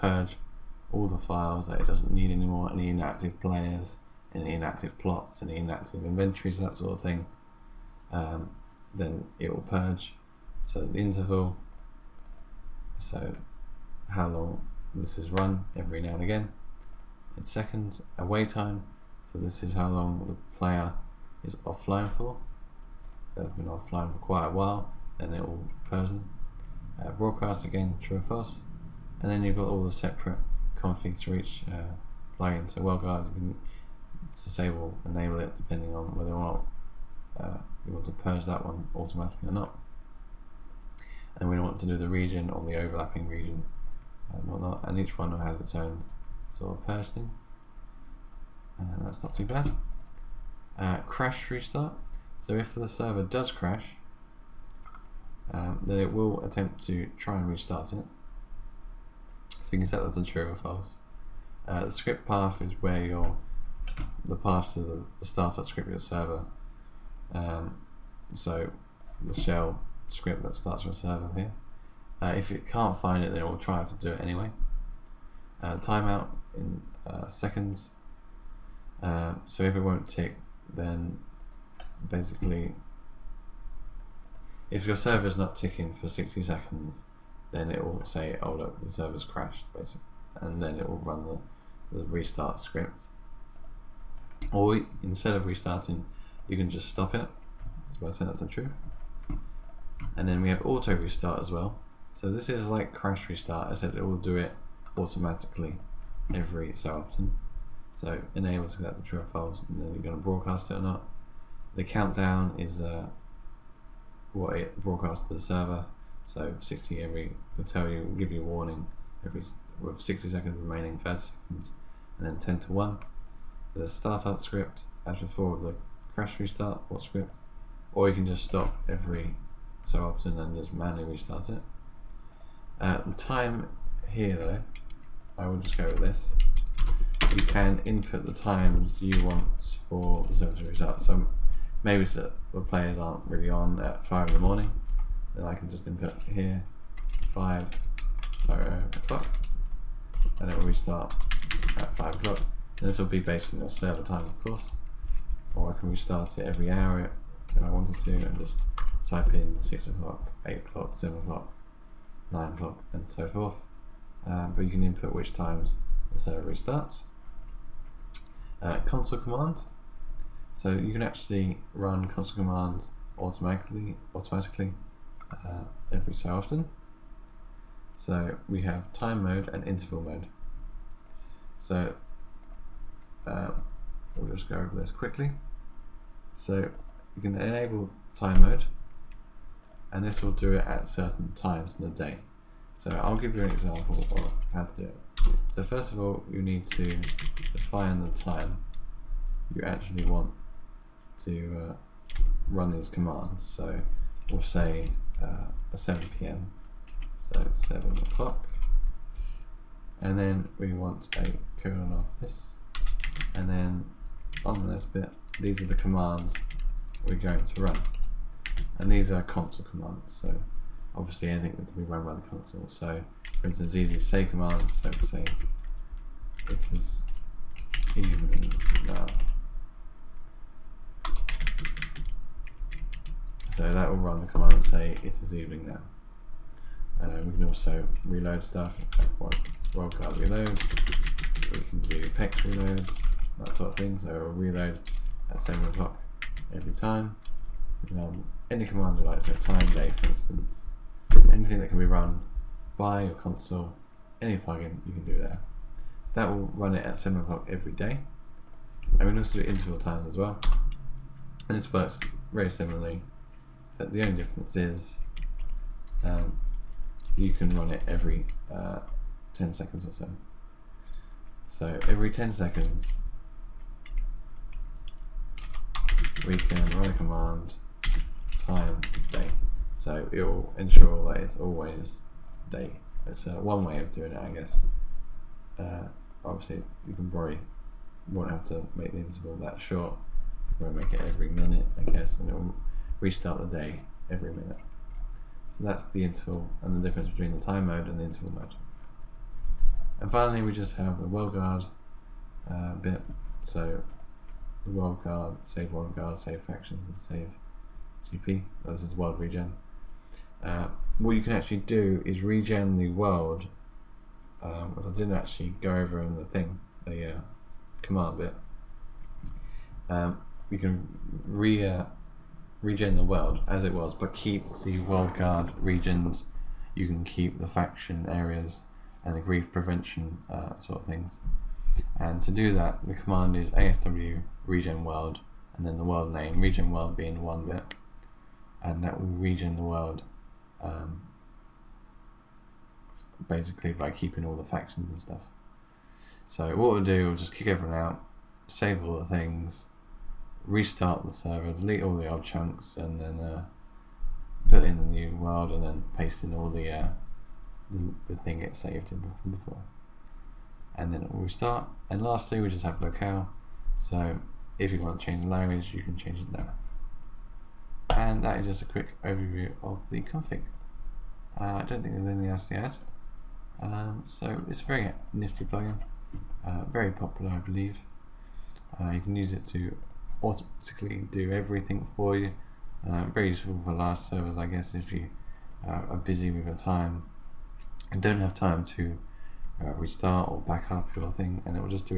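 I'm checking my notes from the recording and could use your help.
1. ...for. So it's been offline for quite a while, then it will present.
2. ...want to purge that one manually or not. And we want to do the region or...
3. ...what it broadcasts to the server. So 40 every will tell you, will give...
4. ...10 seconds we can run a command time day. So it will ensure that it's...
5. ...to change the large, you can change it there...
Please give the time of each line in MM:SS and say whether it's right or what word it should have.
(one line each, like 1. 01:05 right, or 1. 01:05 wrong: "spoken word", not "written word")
1. 00:22 right
2. 00:37 wrong: "automatically", not "manually"
3. 01:54 wrong: "60", not "40"
4. 04:32 right
5. 06:04 wrong: "language", not "large".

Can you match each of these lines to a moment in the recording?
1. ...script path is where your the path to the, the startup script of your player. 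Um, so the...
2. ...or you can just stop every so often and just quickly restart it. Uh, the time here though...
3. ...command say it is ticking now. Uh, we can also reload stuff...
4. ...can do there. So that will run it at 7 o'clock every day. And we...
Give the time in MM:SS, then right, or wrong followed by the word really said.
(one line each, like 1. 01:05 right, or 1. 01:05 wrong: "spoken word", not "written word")
1. 01:01 wrong: "server", not "player"
2. 02:07 wrong: "manually", not "quickly"
3. 03:54 wrong: "evening", not "ticking"
4. 04:14 right.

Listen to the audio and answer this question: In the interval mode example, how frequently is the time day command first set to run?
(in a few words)
every 10 seconds.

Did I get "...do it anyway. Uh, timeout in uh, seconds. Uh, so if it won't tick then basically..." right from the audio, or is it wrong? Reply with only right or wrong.
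right.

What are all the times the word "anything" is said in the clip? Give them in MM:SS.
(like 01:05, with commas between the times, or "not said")
03:41, 04:11, 06:12.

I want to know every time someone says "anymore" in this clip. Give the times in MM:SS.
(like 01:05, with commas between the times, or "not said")
00:02.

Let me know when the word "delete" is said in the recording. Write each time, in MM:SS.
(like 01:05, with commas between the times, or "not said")
05:51.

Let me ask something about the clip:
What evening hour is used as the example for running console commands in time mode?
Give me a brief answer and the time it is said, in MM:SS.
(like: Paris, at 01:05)
7 p.m., at 03:25.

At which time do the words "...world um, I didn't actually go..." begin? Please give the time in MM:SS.
05:12.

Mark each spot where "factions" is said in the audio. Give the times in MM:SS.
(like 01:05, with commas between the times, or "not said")
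05:06, 05:27, 05:44.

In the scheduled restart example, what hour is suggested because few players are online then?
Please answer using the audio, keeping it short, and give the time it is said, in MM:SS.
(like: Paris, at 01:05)
5 in the morning, at 02:24.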